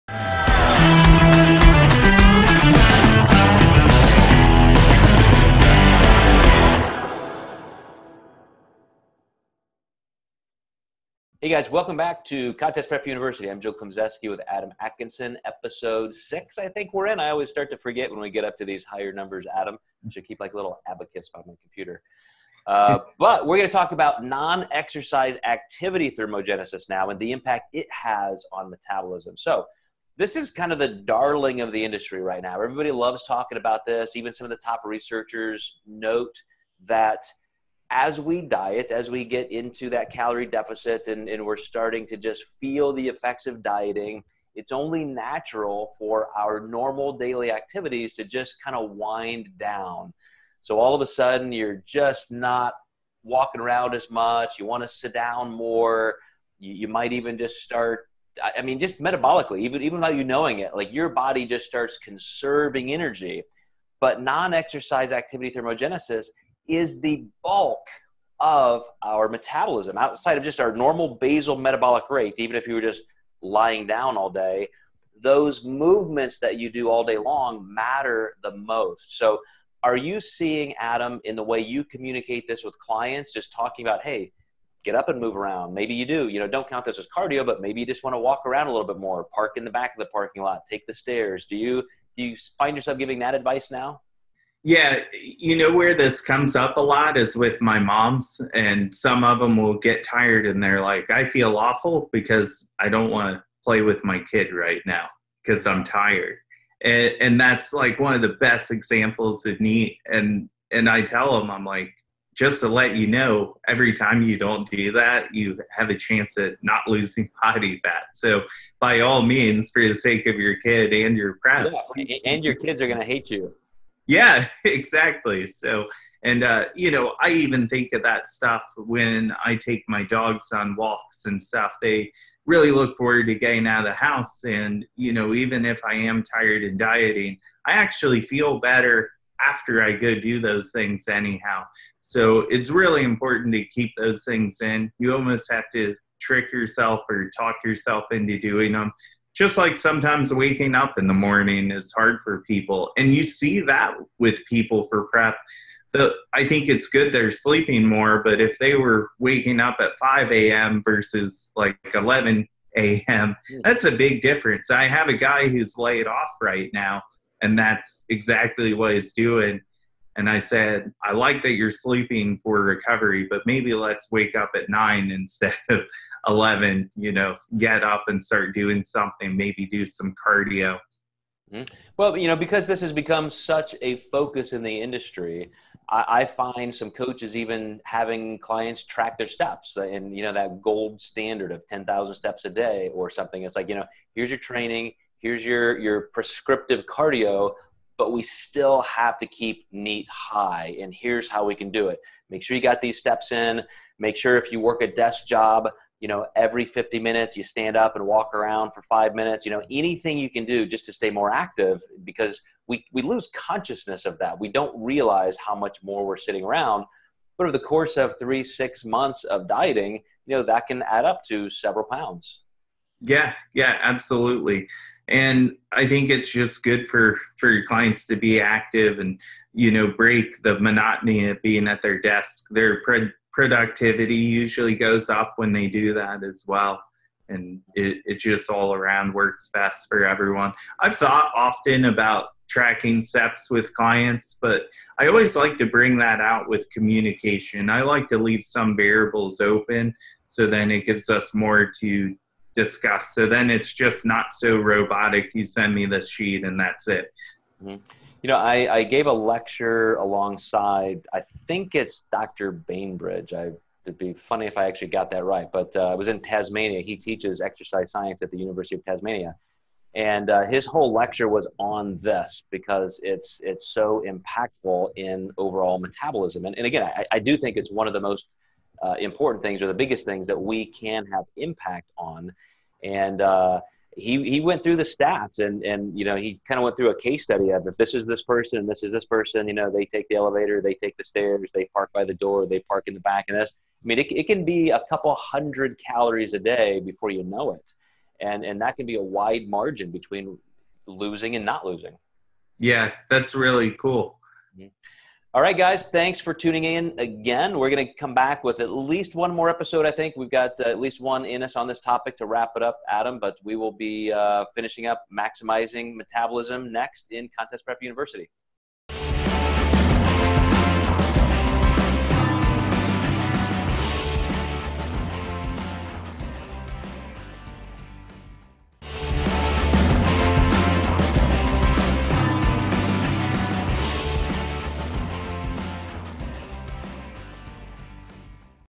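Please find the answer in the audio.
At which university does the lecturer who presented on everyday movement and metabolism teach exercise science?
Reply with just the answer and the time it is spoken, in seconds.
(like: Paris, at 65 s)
University of Tasmania, at 268 s.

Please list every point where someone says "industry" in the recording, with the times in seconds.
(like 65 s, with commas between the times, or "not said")
31 s, 184 s.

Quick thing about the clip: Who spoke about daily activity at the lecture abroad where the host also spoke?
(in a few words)
Dr. Bainbridge.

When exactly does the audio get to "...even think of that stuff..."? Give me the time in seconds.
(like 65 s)
127 s.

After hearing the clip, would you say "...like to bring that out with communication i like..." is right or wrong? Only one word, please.
right.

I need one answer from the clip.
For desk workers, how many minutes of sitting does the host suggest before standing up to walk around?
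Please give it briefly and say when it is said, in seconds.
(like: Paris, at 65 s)
50 minutes, at 206 s.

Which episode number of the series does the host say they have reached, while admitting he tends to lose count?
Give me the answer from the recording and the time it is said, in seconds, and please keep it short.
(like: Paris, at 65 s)
6, at 15 s.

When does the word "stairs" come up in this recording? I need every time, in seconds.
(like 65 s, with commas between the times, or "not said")
90 s, 291 s.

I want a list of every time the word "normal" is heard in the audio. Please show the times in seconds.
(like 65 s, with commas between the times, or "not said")
46 s, 70 s.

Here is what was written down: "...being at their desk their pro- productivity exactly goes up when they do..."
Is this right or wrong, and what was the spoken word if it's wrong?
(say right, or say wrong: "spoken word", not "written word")
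wrong: "usually", not "exactly".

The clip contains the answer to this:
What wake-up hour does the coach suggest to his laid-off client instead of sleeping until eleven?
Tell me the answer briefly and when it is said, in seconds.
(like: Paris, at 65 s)
9, at 174 s.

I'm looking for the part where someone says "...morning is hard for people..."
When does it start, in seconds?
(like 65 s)
151 s.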